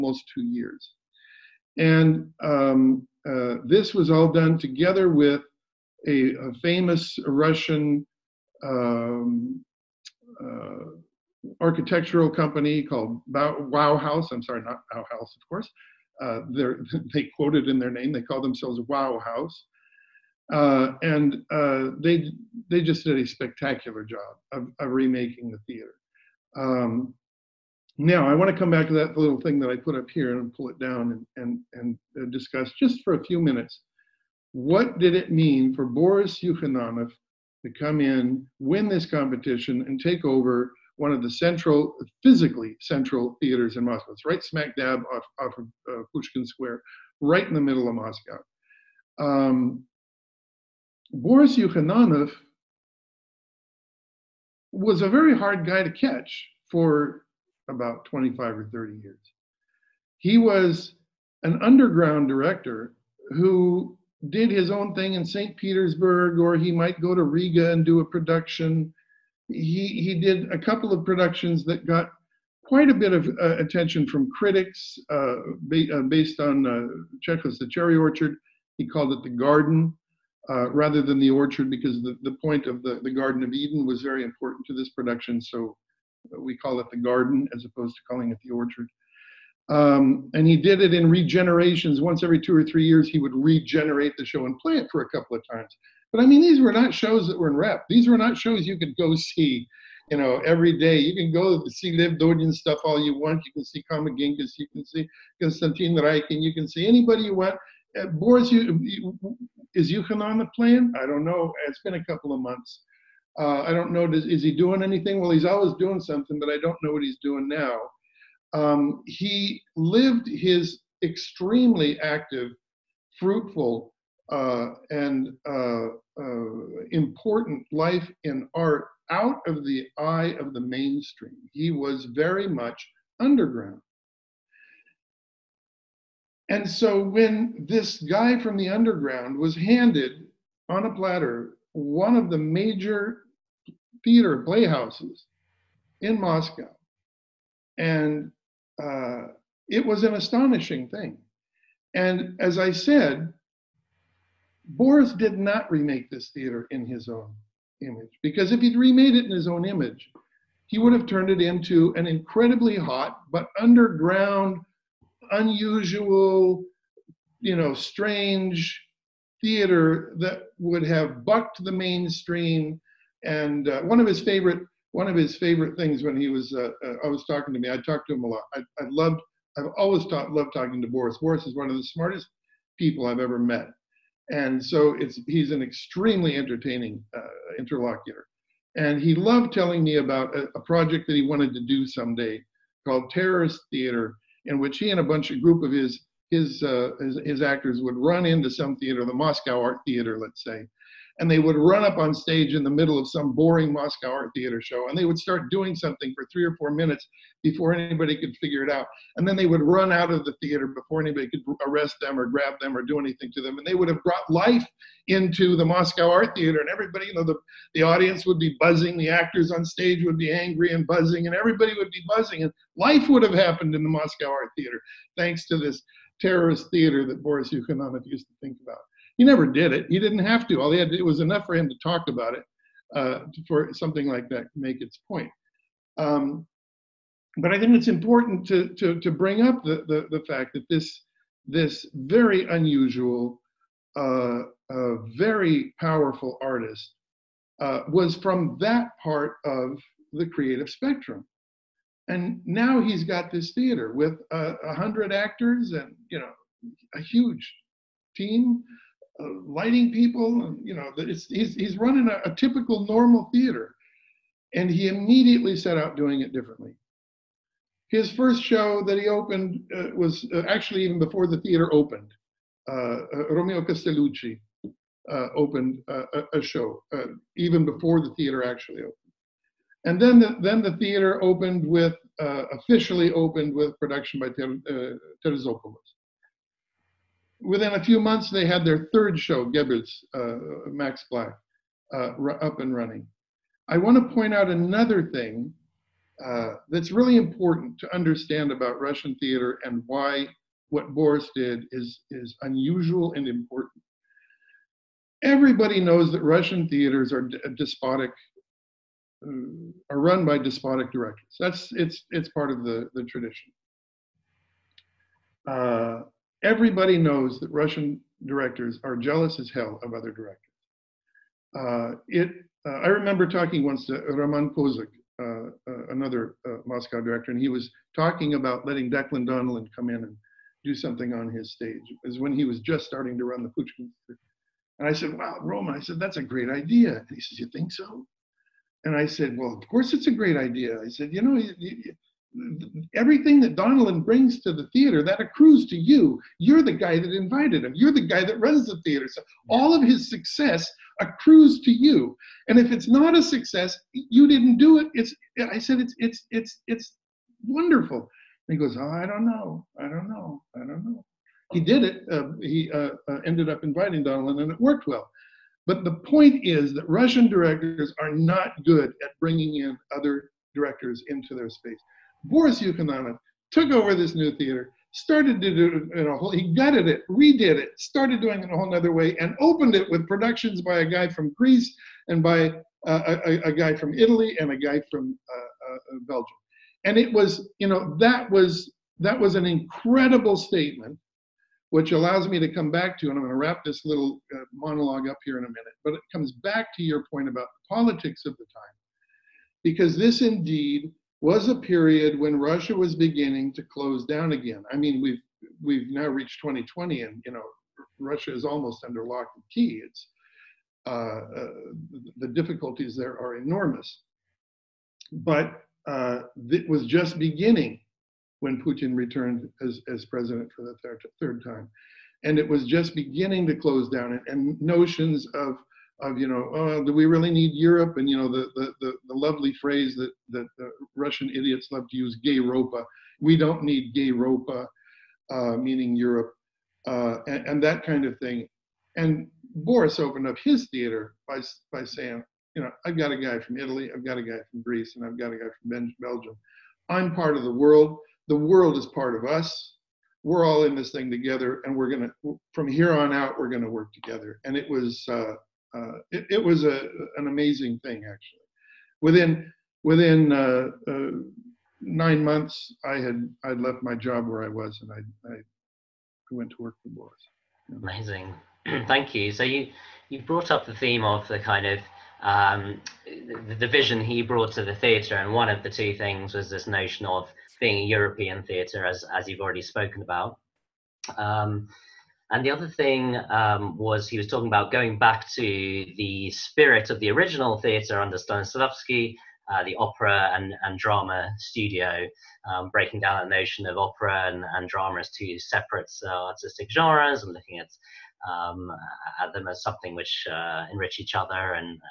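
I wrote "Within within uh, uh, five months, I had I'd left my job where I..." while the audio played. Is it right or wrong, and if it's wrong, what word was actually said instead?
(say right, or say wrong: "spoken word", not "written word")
wrong: "nine", not "five".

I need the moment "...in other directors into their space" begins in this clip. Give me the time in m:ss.
6:09.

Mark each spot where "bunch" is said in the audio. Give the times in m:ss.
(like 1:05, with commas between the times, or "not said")
3:15.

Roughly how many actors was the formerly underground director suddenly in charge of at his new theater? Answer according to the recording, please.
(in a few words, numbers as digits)
100.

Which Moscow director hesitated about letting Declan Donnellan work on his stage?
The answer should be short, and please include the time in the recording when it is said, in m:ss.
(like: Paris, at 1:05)
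Roman Kozak, at 5:24.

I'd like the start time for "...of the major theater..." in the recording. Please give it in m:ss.
2:22.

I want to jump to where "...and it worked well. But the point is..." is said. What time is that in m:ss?
6:04.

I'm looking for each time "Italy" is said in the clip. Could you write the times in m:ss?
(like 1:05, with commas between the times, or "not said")
6:23, 7:23.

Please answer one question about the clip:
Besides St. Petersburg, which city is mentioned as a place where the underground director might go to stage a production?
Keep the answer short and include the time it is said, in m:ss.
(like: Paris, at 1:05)
Riga, at 1:07.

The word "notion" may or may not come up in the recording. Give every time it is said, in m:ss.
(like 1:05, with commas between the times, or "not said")
7:04, 7:56, 8:13.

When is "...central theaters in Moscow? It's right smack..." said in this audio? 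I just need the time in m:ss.
0:42.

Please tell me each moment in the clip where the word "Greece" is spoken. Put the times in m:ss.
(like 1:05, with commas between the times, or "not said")
6:21, 7:24.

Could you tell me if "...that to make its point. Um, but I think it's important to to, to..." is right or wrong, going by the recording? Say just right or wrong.
right.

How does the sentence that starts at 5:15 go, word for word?
Uh, everybody knows that Russian directors are jealous as hell of other directors.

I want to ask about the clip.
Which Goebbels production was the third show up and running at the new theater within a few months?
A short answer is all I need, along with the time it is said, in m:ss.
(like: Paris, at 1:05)
Max Black, at 4:50.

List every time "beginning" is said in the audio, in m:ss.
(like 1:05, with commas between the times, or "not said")
6:42, 6:57, 7:02.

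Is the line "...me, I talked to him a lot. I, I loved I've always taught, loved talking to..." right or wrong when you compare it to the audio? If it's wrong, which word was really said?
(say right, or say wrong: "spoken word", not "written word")
right.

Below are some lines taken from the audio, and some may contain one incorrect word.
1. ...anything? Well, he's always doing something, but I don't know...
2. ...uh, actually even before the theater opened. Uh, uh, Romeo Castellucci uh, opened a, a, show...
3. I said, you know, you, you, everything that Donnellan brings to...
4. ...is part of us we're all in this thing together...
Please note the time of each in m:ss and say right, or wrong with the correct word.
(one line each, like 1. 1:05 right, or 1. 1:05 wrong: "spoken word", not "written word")
1. 1:54 right
2. 4:30 right
3. 5:40 right
4. 7:28 right.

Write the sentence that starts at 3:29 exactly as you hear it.
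And then they would run out of the theater before anybody could arrest them or grab them or do anything to them.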